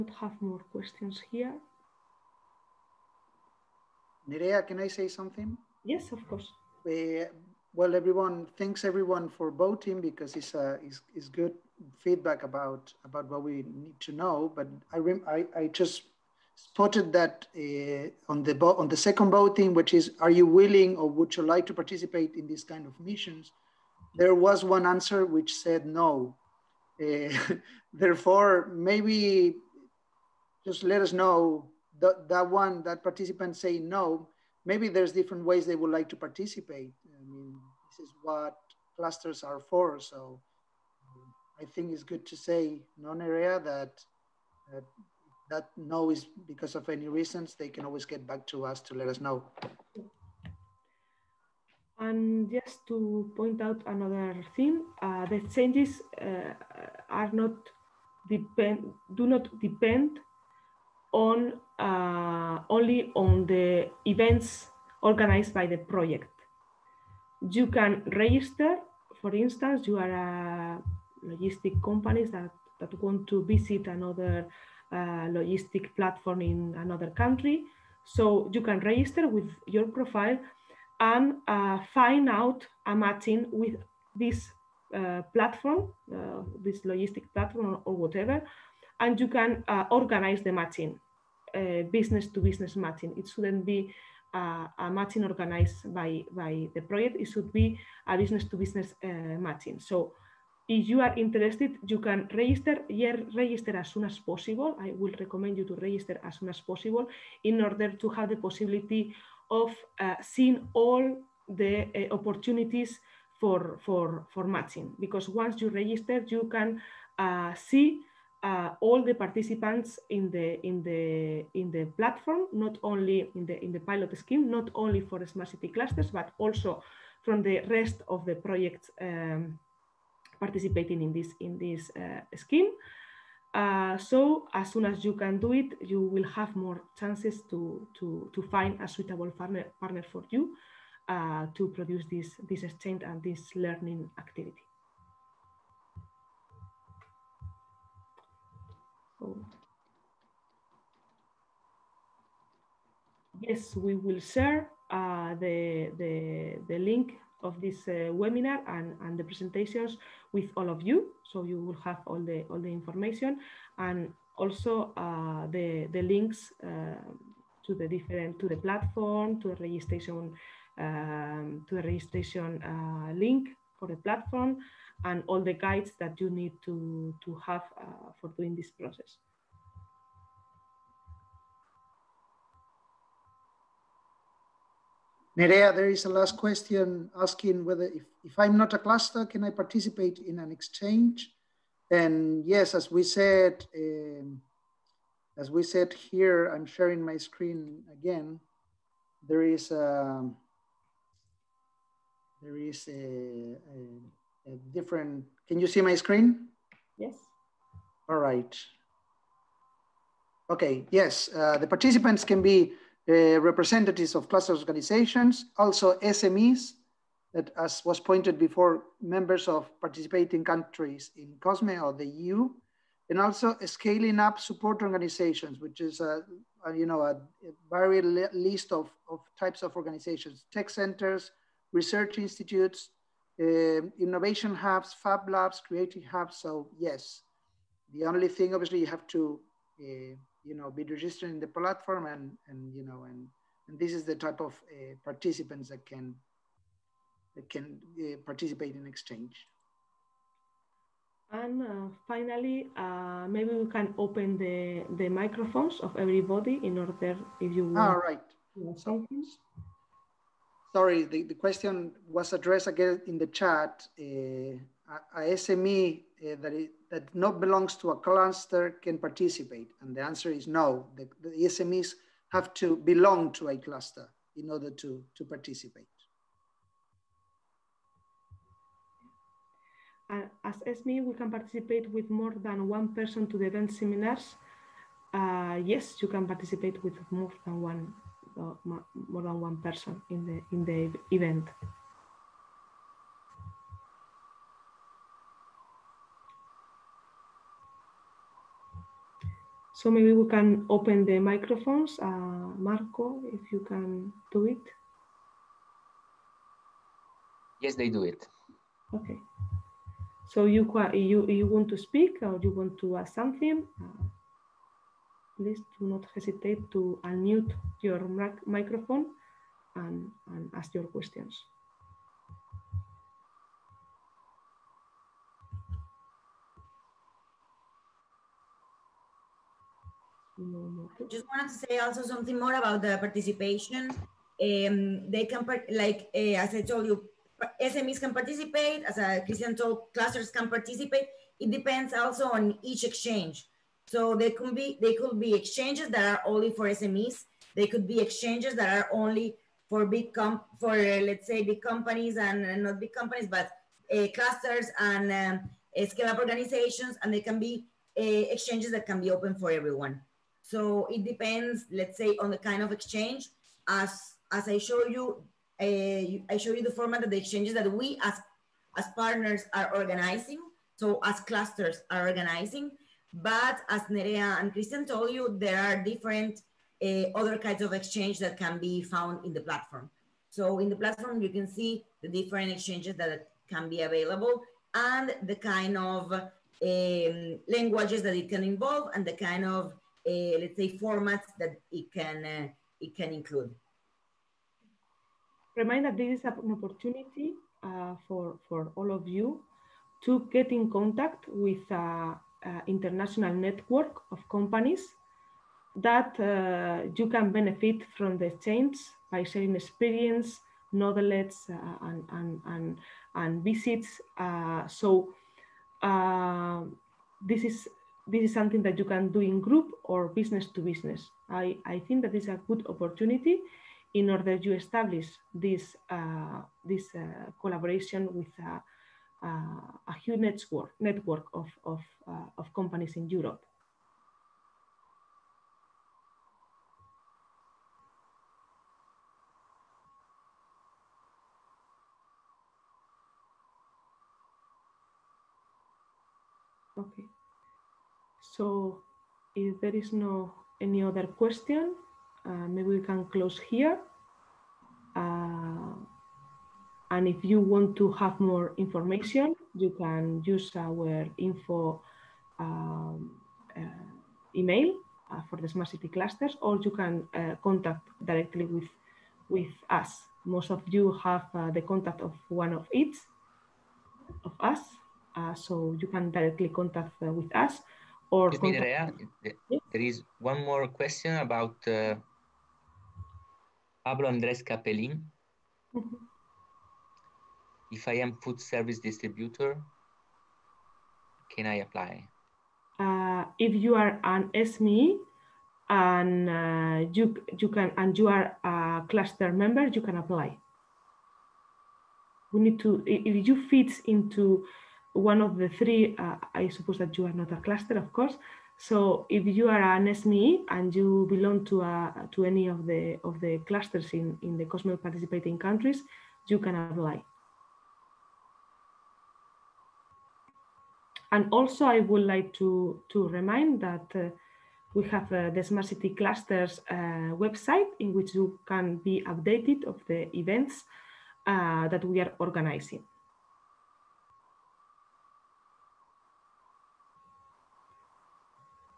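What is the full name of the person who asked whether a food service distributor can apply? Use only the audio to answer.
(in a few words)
Pablo Andres Capelin.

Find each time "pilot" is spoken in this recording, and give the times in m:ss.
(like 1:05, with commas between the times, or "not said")
2:03.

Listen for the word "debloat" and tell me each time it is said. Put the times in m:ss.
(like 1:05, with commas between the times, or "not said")
not said.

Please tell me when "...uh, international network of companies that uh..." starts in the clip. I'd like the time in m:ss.
6:42.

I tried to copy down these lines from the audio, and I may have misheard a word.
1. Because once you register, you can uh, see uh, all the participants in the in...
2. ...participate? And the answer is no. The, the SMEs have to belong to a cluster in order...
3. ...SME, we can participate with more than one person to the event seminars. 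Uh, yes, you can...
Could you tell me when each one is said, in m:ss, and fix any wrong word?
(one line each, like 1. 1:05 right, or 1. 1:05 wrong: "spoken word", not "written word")
1. 1:54 right
2. 4:28 right
3. 4:40 right.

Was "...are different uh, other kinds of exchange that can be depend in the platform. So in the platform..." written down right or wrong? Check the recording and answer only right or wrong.
wrong.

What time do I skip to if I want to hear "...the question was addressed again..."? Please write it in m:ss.
4:21.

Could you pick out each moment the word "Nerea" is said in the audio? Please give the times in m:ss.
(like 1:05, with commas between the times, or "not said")
0:04, 3:05, 6:13.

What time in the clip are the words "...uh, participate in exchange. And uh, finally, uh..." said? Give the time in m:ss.
4:08.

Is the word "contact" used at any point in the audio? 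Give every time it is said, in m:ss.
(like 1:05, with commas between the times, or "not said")
6:40, 7:47, 7:51, 7:56.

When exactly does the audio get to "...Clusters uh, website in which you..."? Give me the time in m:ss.
8:45.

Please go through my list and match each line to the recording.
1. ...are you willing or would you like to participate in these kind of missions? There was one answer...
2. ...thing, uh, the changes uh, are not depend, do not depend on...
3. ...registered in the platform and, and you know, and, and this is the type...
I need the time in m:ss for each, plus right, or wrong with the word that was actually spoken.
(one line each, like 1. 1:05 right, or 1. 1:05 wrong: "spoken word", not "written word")
1. 0:20 right
2. 0:54 right
3. 4:00 right.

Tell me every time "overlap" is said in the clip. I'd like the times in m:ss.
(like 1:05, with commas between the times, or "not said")
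not said.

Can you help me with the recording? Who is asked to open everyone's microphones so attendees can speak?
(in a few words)
Marco.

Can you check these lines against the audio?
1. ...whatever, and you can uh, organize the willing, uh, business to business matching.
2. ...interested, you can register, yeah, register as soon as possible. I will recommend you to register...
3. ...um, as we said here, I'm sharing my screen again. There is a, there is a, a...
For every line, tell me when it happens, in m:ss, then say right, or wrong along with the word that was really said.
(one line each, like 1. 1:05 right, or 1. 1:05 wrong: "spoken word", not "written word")
1. 1:27 wrong: "matching", not "willing"
2. 1:41 right
3. 3:13 right.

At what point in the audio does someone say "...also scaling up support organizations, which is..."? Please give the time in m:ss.
3:43.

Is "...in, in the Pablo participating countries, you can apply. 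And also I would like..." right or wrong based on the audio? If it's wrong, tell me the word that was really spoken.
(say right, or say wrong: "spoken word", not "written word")
wrong: "COSME", not "Pablo".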